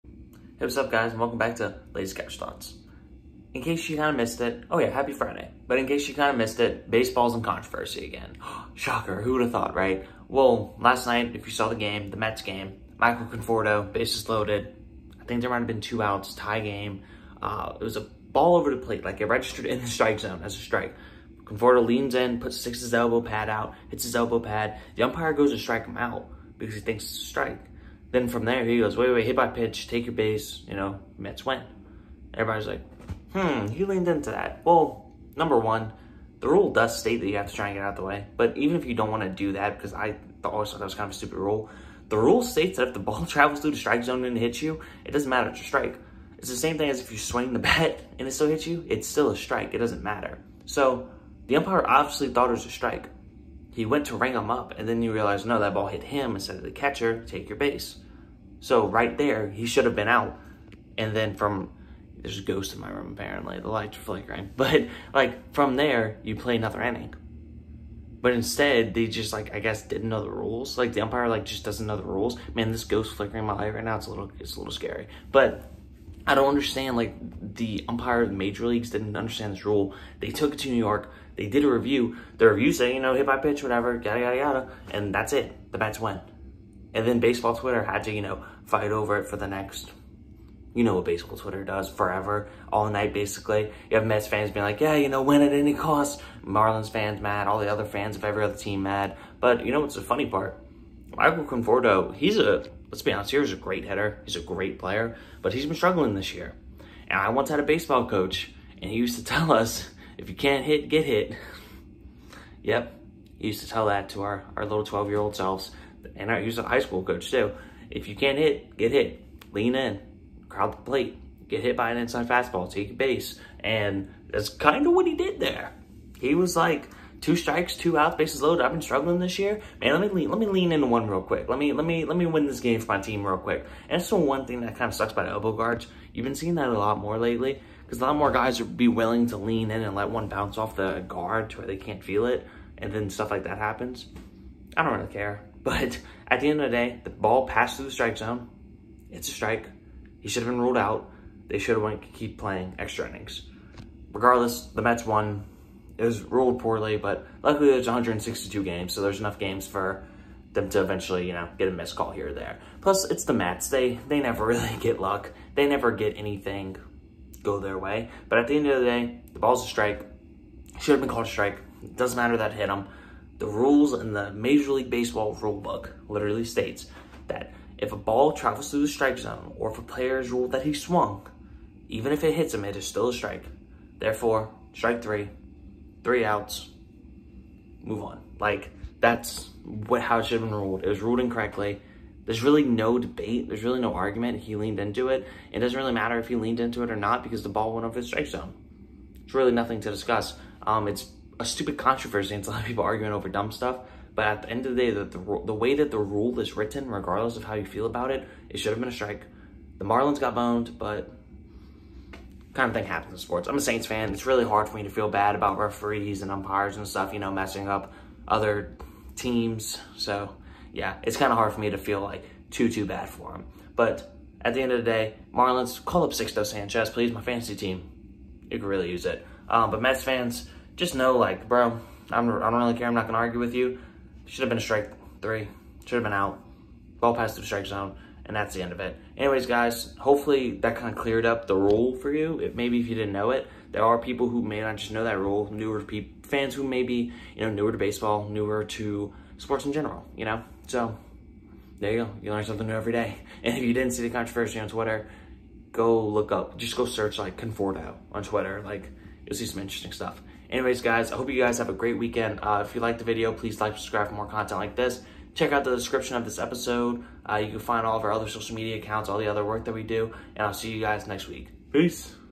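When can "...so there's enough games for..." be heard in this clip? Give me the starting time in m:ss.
2:38.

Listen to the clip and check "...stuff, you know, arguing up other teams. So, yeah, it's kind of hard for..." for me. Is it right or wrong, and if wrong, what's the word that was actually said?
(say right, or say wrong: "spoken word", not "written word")
wrong: "messing", not "arguing".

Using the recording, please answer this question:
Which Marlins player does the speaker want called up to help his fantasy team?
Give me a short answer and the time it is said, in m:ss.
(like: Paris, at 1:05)
Sixto Sanchez, at 3:46.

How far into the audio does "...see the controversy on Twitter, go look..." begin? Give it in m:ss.
4:13.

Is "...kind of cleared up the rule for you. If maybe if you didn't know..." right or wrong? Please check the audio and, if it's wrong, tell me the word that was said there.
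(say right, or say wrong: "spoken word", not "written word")
right.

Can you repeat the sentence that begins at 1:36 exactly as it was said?
Marlins fans mad, all the other fans of every other team mad.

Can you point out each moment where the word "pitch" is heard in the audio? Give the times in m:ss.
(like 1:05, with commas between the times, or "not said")
0:29, 1:23.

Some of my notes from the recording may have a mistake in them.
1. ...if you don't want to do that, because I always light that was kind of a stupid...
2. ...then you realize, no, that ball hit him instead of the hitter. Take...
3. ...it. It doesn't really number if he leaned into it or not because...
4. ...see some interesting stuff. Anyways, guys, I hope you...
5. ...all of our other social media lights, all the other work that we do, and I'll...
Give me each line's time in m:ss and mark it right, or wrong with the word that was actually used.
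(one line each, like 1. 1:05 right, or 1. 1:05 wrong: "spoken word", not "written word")
1. 0:38 wrong: "thought", not "light"
2. 0:54 wrong: "catcher", not "hitter"
3. 3:15 wrong: "matter", not "number"
4. 4:19 right
5. 4:27 wrong: "accounts", not "lights".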